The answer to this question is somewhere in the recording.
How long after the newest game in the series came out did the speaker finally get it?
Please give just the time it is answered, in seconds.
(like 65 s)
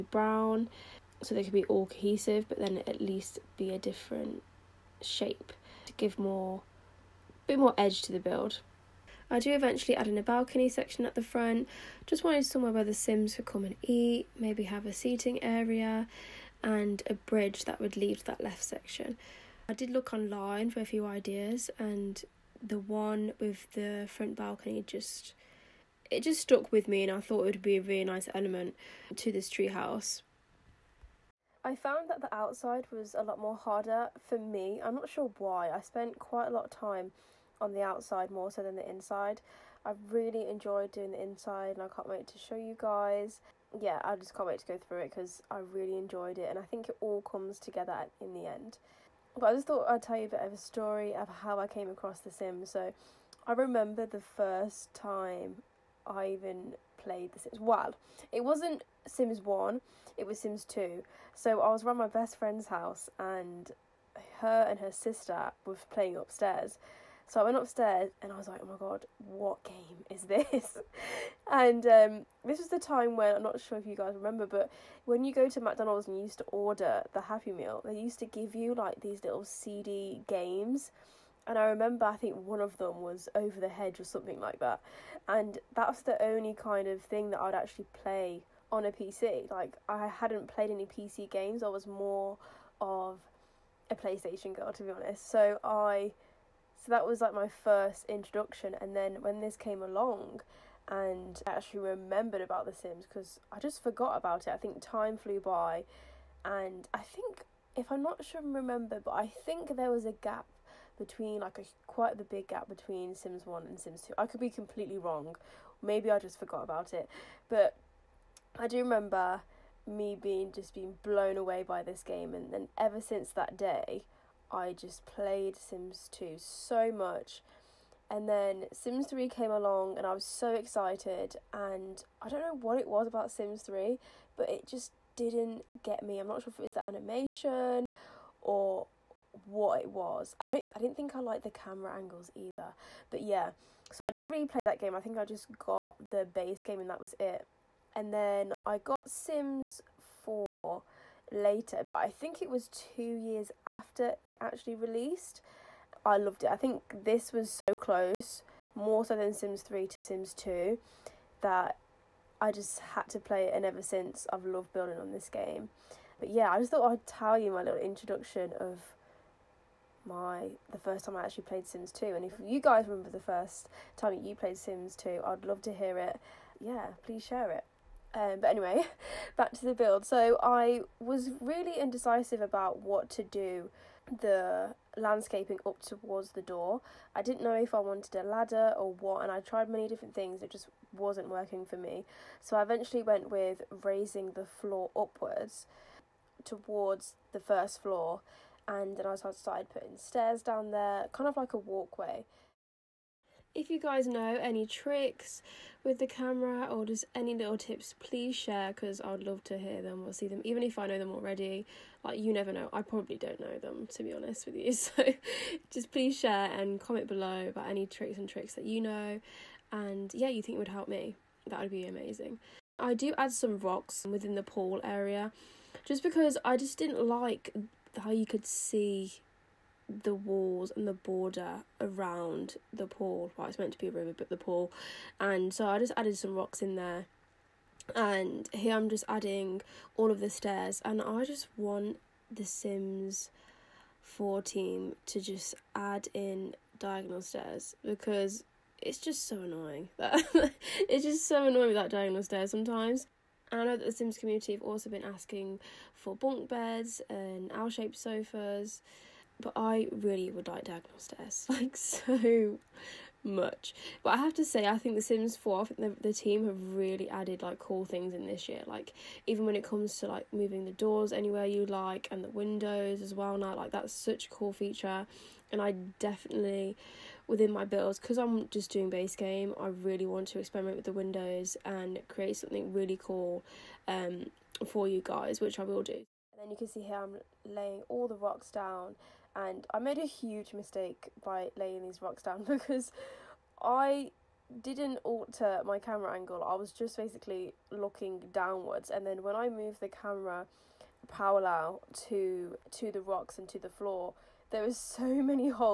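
152 s.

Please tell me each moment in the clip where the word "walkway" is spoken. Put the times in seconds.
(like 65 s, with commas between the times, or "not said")
201 s.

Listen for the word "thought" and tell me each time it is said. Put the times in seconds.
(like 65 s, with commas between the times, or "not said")
27 s, 49 s, 166 s.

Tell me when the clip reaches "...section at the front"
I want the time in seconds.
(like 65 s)
10 s.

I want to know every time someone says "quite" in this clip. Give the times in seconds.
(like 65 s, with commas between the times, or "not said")
36 s, 111 s.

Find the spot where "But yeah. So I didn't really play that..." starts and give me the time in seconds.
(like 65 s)
143 s.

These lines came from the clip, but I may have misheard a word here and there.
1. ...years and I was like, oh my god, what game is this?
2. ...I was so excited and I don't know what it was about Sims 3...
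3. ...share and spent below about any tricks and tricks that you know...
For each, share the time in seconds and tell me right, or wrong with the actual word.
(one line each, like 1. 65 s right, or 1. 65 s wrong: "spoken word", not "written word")
1. 67 s wrong: "upstairs", not "years"
2. 130 s right
3. 216 s wrong: "comment", not "spent".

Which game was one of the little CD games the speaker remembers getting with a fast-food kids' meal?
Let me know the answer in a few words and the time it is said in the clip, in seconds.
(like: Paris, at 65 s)
Over the Hedge, at 83 s.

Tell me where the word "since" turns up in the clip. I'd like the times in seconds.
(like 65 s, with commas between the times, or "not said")
123 s, 163 s.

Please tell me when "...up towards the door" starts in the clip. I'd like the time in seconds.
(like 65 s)
185 s.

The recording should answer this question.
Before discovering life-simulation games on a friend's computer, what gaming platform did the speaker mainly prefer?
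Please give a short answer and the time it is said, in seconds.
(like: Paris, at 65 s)
PlayStation, at 93 s.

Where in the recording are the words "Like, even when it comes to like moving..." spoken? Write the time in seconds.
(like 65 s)
268 s.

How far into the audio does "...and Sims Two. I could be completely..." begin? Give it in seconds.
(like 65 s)
113 s.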